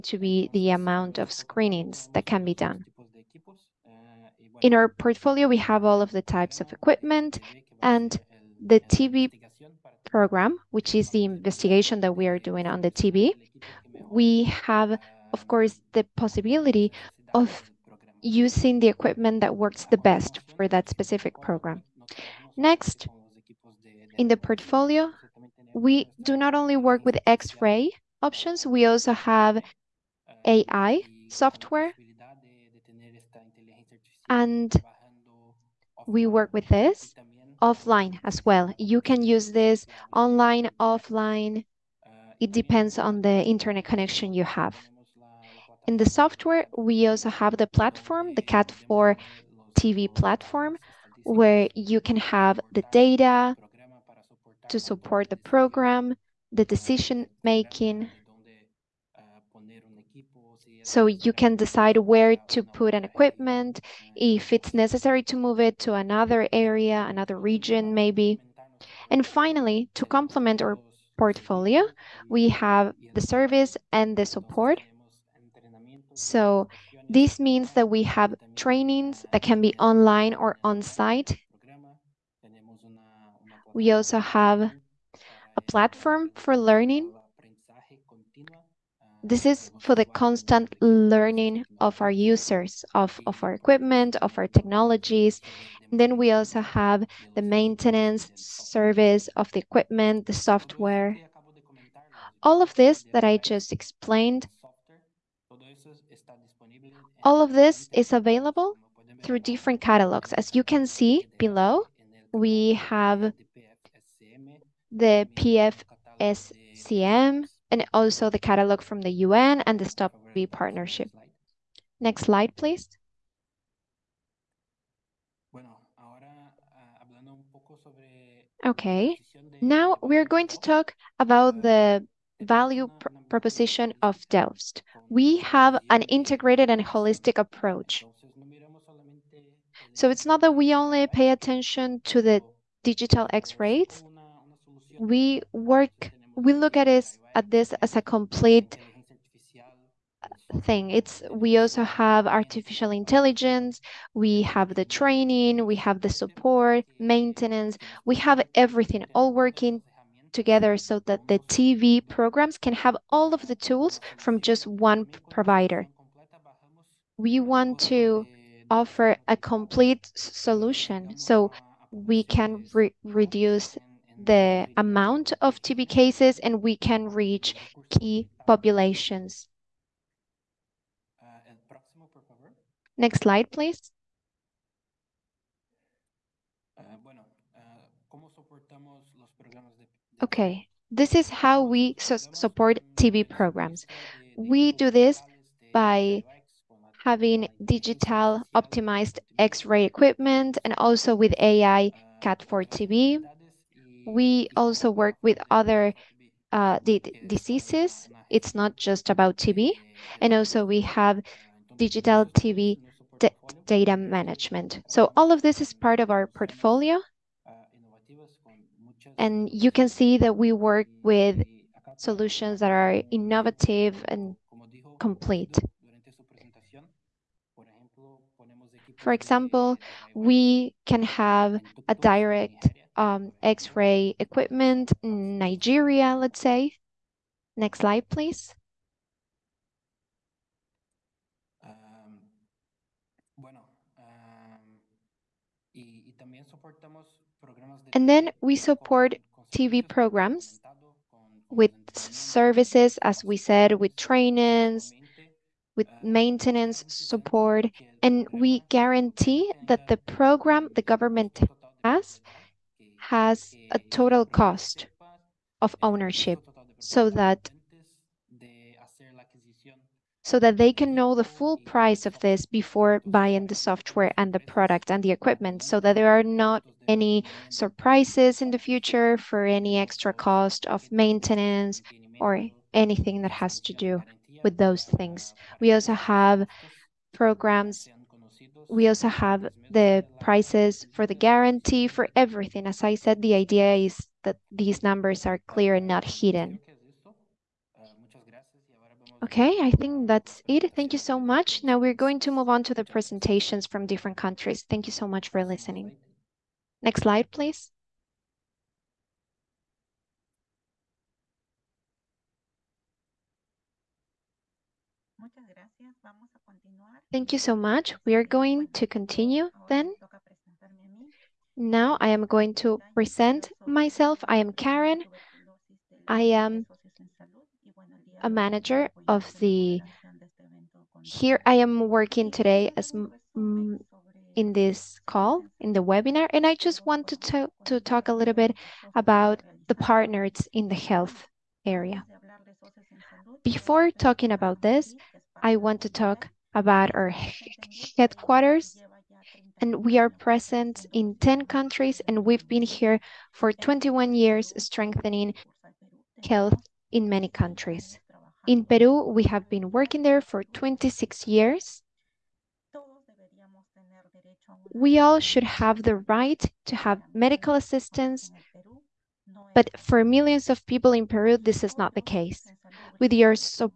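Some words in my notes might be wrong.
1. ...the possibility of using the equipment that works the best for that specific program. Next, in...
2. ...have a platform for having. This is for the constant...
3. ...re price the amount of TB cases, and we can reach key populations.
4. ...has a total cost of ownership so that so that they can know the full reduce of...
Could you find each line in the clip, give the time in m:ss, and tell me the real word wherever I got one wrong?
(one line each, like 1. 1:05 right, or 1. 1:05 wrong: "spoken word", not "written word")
1. 0:15 right
2. 1:24 wrong: "learning", not "having"
3. 2:52 wrong: "reduce", not "price"
4. 4:23 wrong: "price", not "reduce".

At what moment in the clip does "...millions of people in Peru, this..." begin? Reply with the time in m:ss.
6:10.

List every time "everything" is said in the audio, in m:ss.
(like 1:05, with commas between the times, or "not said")
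2:38, 4:52.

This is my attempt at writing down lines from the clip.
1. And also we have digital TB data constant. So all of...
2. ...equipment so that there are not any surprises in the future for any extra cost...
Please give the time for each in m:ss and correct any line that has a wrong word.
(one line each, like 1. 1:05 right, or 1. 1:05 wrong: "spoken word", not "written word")
1. 3:30 wrong: "management", not "constant"
2. 4:35 right.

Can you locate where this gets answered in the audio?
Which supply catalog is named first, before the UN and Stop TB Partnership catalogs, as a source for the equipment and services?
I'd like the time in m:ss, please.
1:56.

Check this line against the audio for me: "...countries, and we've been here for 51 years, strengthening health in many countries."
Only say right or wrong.
wrong.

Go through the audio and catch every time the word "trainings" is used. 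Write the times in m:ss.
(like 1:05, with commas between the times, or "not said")
1:18, 2:34, 4:13.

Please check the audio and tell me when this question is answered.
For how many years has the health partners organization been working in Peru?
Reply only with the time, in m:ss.
6:00.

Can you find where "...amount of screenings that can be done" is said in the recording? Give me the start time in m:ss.
0:00.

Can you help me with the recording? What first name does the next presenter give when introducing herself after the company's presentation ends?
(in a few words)
Karen.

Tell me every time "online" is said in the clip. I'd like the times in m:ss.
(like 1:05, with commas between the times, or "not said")
0:40, 1:19.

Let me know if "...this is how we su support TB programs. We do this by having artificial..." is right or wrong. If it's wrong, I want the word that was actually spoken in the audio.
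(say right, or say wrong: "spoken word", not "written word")
wrong: "digital", not "artificial".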